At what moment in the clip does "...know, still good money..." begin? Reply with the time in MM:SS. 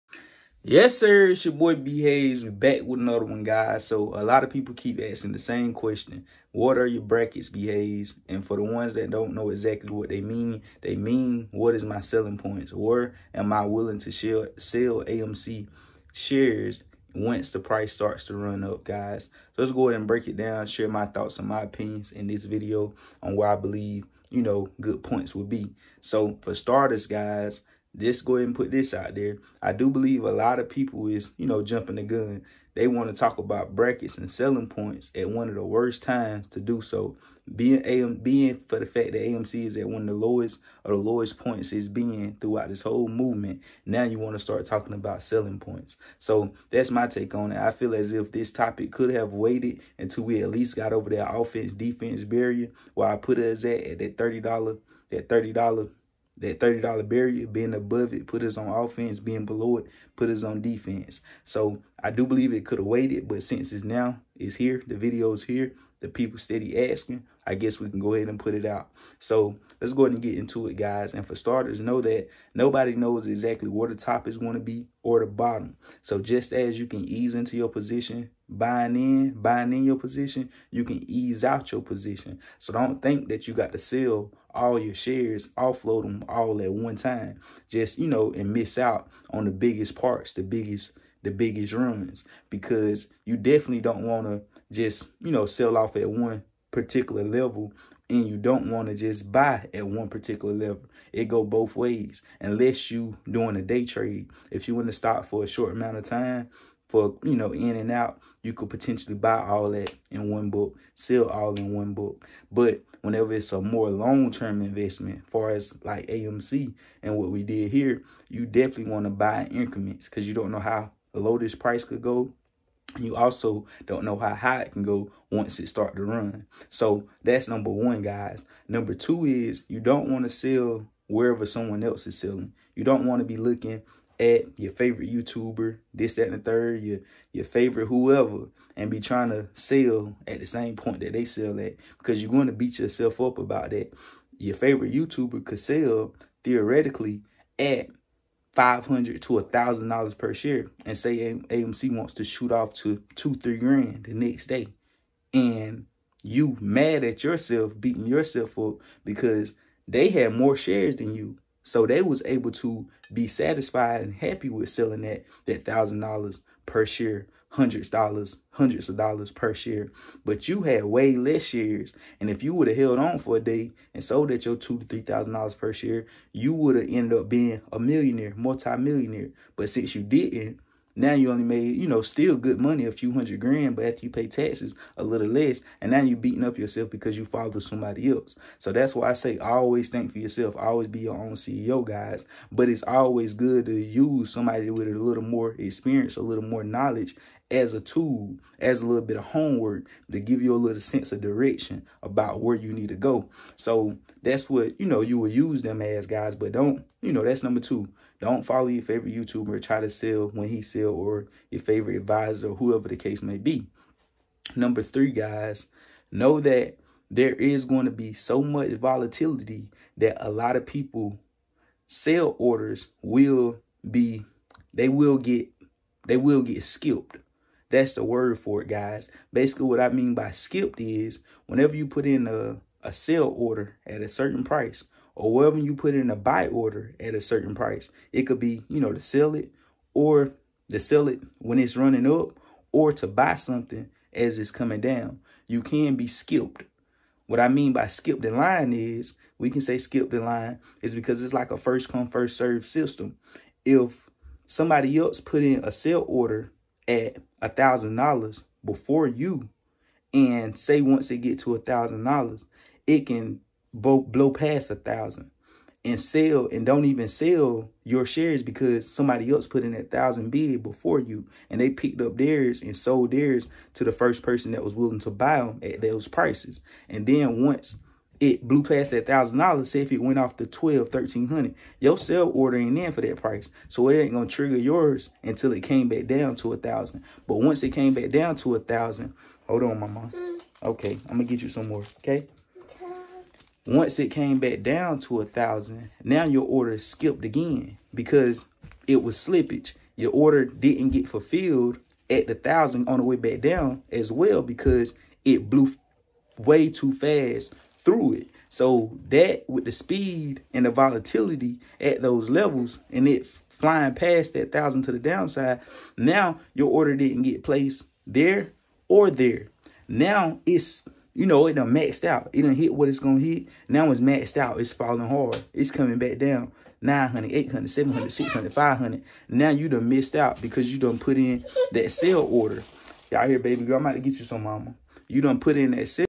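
03:01.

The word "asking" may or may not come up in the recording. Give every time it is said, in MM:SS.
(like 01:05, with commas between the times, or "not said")
00:05, 01:06.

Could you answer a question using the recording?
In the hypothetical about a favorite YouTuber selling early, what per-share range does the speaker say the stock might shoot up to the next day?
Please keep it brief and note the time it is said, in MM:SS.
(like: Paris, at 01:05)
2,000 to 3,000 dollars, at 02:33.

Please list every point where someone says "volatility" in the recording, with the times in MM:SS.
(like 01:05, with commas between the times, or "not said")
03:38, 05:10.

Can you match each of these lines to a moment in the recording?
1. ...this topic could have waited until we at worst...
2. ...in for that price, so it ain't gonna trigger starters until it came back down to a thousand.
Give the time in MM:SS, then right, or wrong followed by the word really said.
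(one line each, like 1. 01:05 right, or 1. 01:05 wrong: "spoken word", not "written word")
1. 00:48 wrong: "least", not "worst"
2. 04:42 wrong: "yours", not "starters".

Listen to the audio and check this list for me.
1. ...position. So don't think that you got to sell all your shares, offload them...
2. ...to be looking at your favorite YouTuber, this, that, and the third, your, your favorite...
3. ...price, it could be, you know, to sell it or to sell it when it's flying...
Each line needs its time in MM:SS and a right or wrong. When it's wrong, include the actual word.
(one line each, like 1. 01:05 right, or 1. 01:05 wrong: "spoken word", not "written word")
1. 01:21 right
2. 02:13 right
3. 03:57 wrong: "running", not "flying".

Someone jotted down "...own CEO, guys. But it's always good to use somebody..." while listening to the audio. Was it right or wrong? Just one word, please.
right.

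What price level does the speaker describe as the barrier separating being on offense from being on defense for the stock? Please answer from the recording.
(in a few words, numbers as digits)
$30.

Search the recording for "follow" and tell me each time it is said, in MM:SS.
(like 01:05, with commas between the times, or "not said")
03:07, 03:28.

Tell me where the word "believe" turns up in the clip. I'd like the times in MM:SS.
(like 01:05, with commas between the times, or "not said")
00:23, 00:29, 01:02.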